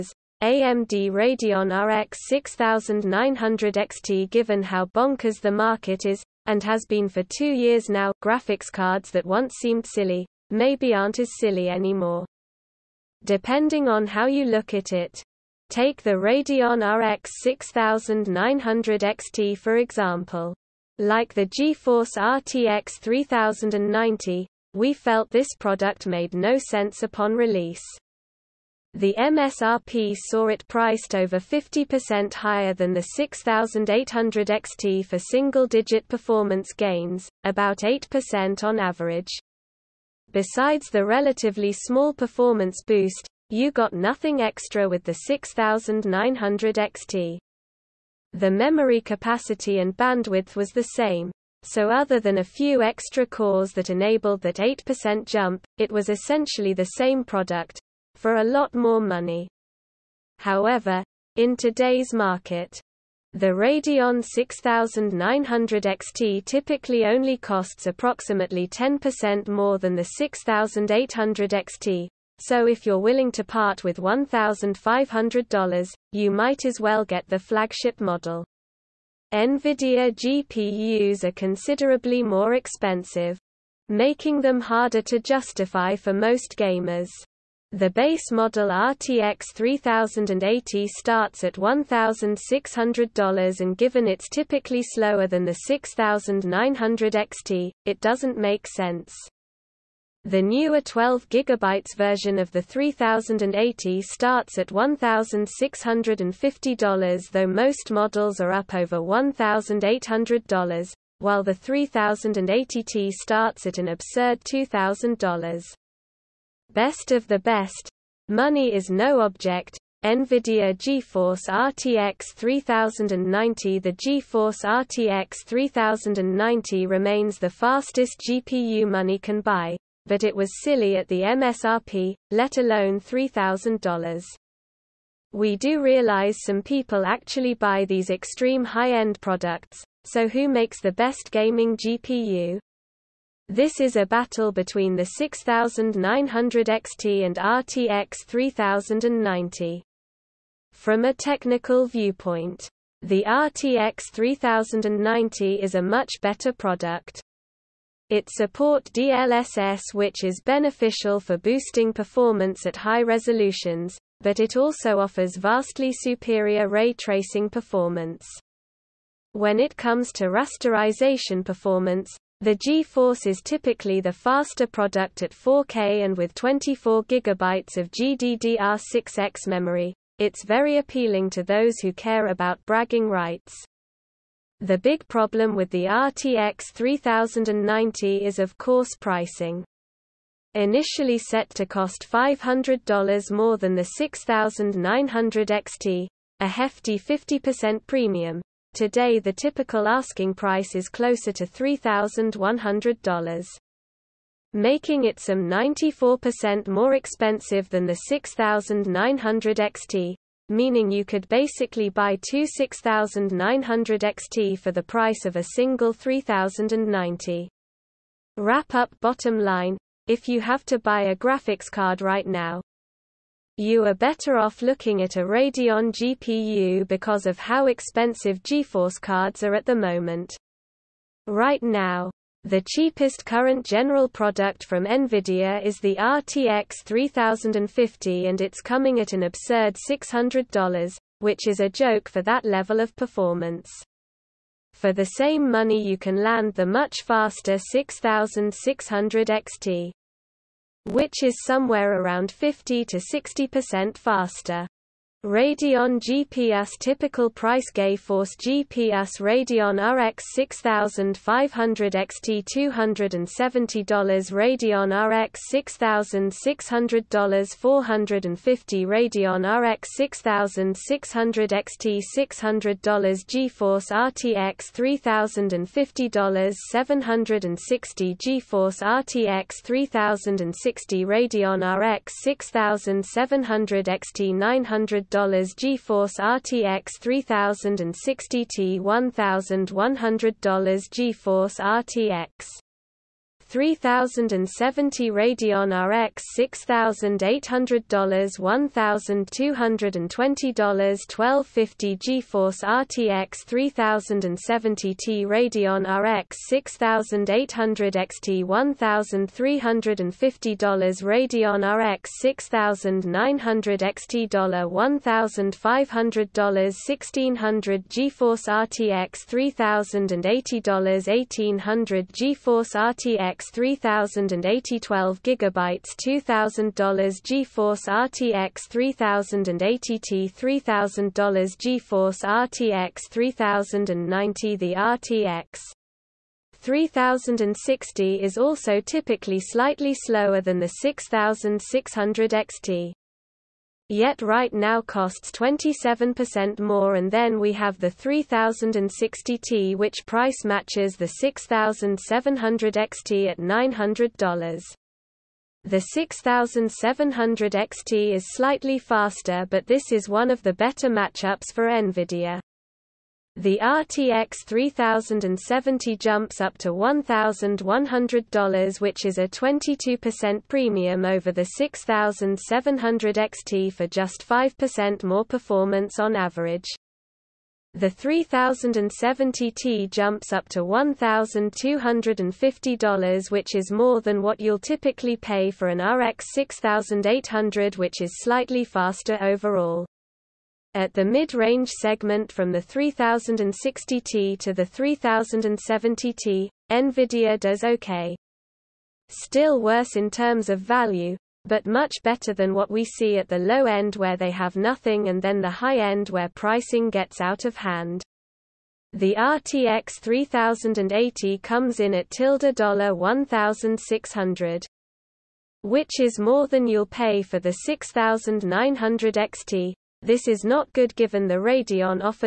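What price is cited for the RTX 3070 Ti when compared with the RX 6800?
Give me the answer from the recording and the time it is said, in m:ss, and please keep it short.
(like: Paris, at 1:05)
$1,250, at 6:20.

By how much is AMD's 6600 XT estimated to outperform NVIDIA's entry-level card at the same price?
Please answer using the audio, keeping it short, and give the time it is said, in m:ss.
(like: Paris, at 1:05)
50 to 60%, at 4:12.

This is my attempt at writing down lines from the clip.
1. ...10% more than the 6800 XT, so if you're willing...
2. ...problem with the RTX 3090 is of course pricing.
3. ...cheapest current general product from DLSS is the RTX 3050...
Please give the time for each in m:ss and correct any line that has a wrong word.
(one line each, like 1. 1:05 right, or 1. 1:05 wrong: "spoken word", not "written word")
1. 1:08 right
2. 3:05 right
3. 3:52 wrong: "Nvidia", not "DLSS".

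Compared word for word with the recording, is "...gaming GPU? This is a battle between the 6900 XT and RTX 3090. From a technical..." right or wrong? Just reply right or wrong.
right.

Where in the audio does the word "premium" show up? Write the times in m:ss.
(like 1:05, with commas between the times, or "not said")
3:17, 6:10.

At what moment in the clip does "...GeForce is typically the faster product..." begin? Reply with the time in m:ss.
2:52.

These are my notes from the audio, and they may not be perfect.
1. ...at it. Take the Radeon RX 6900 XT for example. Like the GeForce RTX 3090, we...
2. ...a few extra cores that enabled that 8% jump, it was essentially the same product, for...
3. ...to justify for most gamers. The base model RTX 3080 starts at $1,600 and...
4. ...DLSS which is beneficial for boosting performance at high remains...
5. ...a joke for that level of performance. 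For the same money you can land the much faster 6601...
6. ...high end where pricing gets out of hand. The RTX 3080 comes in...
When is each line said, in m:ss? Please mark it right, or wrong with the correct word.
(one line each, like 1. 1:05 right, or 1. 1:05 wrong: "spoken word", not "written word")
1. 0:14 right
2. 0:52 right
3. 1:25 right
4. 2:38 wrong: "resolutions", not "remains"
5. 4:01 wrong: "6600", not "6601"
6. 6:45 right.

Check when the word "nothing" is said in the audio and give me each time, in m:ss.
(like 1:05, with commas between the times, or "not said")
0:43, 6:44.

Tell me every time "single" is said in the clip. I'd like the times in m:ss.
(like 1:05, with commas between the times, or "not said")
0:35, 3:35.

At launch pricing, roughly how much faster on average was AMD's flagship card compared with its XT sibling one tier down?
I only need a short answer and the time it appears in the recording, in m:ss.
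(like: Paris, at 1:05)
8%, at 0:37.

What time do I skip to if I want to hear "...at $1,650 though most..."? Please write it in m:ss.
1:44.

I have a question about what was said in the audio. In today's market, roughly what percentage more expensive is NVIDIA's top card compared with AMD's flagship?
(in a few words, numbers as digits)
94%.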